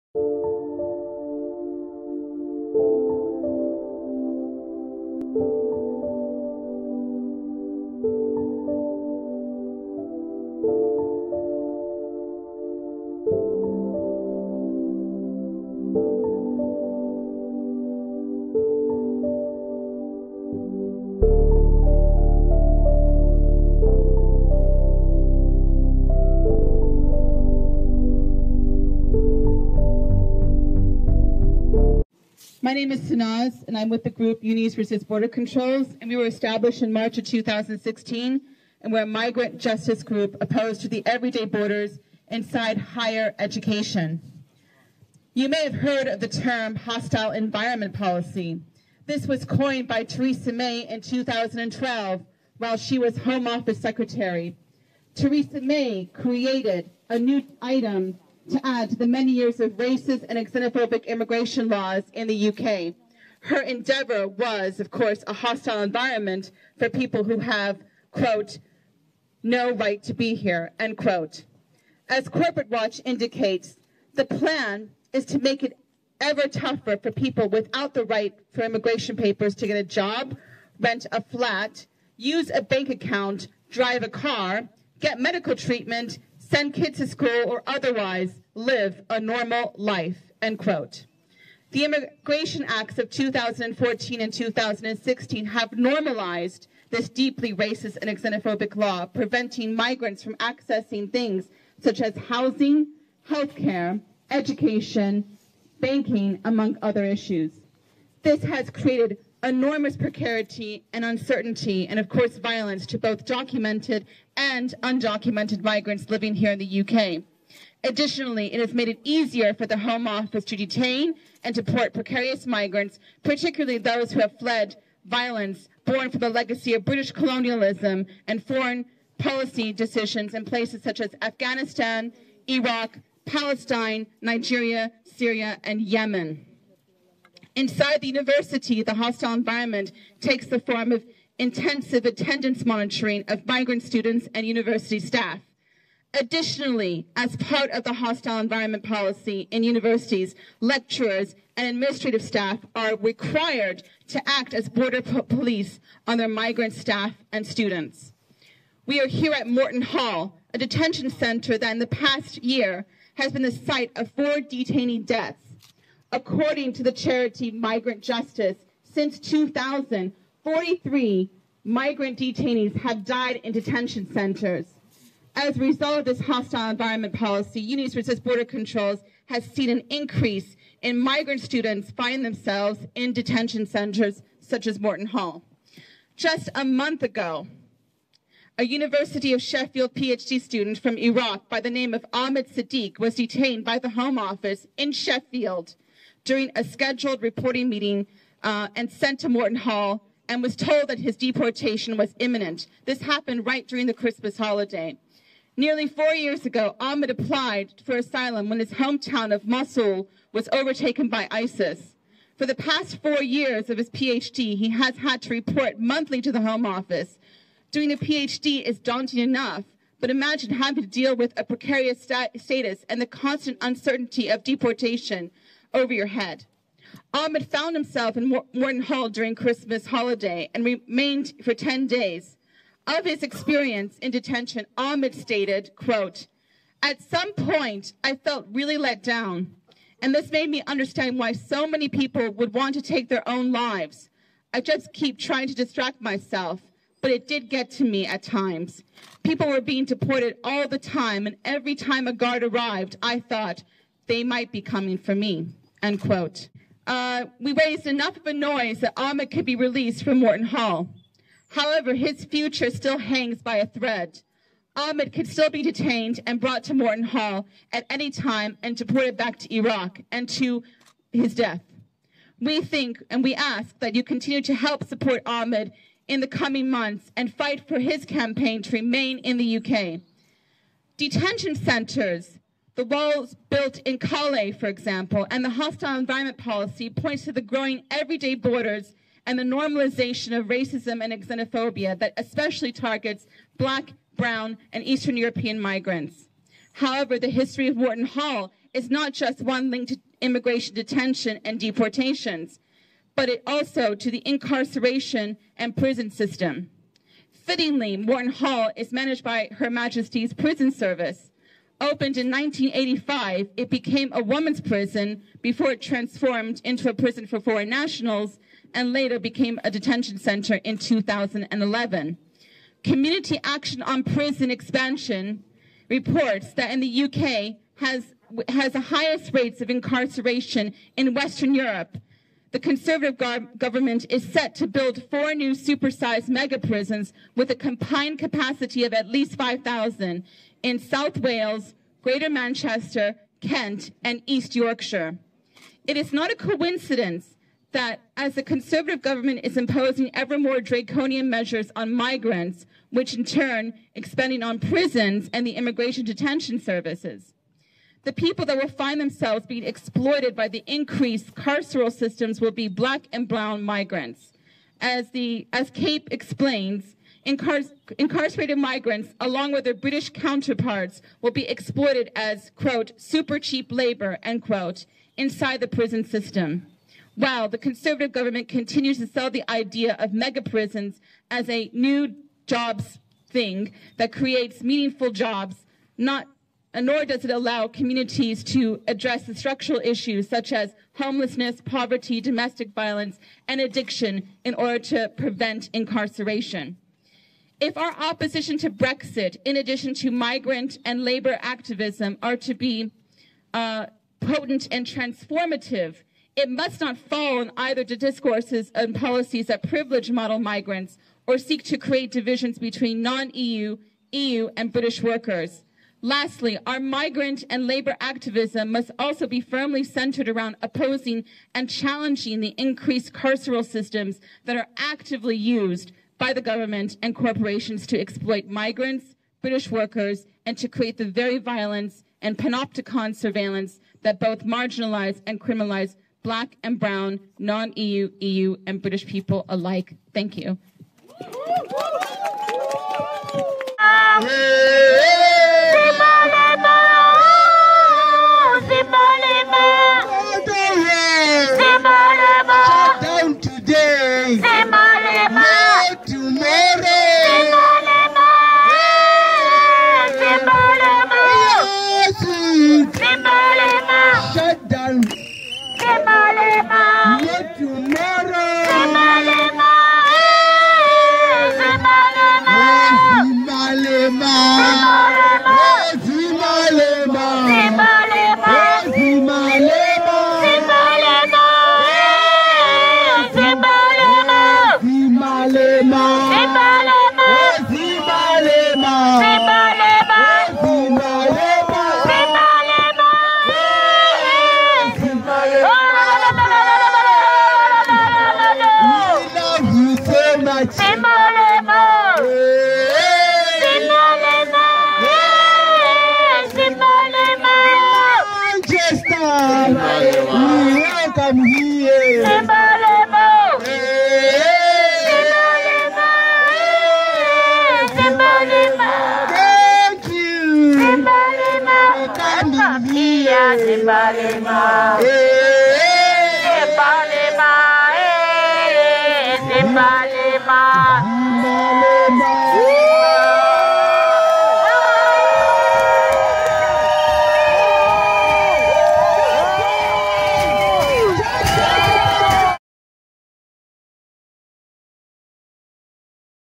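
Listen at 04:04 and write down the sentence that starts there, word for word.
I just keep trying to distract myself, but it did get to me at times.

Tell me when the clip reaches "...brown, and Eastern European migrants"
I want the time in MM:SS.
04:54.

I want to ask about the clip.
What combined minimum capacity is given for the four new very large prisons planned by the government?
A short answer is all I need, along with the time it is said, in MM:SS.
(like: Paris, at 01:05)
5,000, at 05:39.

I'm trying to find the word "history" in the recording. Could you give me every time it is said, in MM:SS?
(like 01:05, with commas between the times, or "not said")
04:57.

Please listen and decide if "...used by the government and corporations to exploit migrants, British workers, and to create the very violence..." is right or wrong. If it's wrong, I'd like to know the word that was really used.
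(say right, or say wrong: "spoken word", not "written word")
right.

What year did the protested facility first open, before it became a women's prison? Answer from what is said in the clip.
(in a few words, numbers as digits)
1985.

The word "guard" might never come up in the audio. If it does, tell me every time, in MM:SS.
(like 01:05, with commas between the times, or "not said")
04:12.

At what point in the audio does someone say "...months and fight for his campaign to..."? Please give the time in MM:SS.
04:36.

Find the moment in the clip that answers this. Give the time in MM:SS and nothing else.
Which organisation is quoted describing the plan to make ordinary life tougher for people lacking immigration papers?
01:12.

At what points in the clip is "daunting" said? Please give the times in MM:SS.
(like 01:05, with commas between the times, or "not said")
03:38.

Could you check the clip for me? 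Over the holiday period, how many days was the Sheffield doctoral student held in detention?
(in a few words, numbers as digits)
10.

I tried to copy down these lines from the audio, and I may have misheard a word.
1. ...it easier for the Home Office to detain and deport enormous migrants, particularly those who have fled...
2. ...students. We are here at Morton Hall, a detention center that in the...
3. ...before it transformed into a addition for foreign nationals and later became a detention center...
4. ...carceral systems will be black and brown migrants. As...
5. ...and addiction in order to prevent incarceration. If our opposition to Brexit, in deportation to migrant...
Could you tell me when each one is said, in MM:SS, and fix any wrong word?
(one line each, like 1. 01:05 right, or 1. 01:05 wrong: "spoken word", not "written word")
1. 01:58 wrong: "precarious", not "enormous"
2. 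02:37 right
3. 05:15 wrong: "prison", not "addition"
4. 06:01 right
5. 06:33 wrong: "addition", not "deportation".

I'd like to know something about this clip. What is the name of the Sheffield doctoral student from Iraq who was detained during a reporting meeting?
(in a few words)
Ahmed Sedeeq.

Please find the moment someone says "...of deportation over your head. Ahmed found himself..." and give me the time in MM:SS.
03:44.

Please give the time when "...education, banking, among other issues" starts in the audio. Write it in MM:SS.
01:44.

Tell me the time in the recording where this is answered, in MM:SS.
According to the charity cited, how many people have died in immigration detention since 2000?
02:50.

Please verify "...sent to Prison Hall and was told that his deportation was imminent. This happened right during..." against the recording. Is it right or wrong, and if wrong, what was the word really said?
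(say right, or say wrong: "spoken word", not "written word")
wrong: "Morton", not "Prison".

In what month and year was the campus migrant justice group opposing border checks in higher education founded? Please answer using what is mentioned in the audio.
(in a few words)
March 2016.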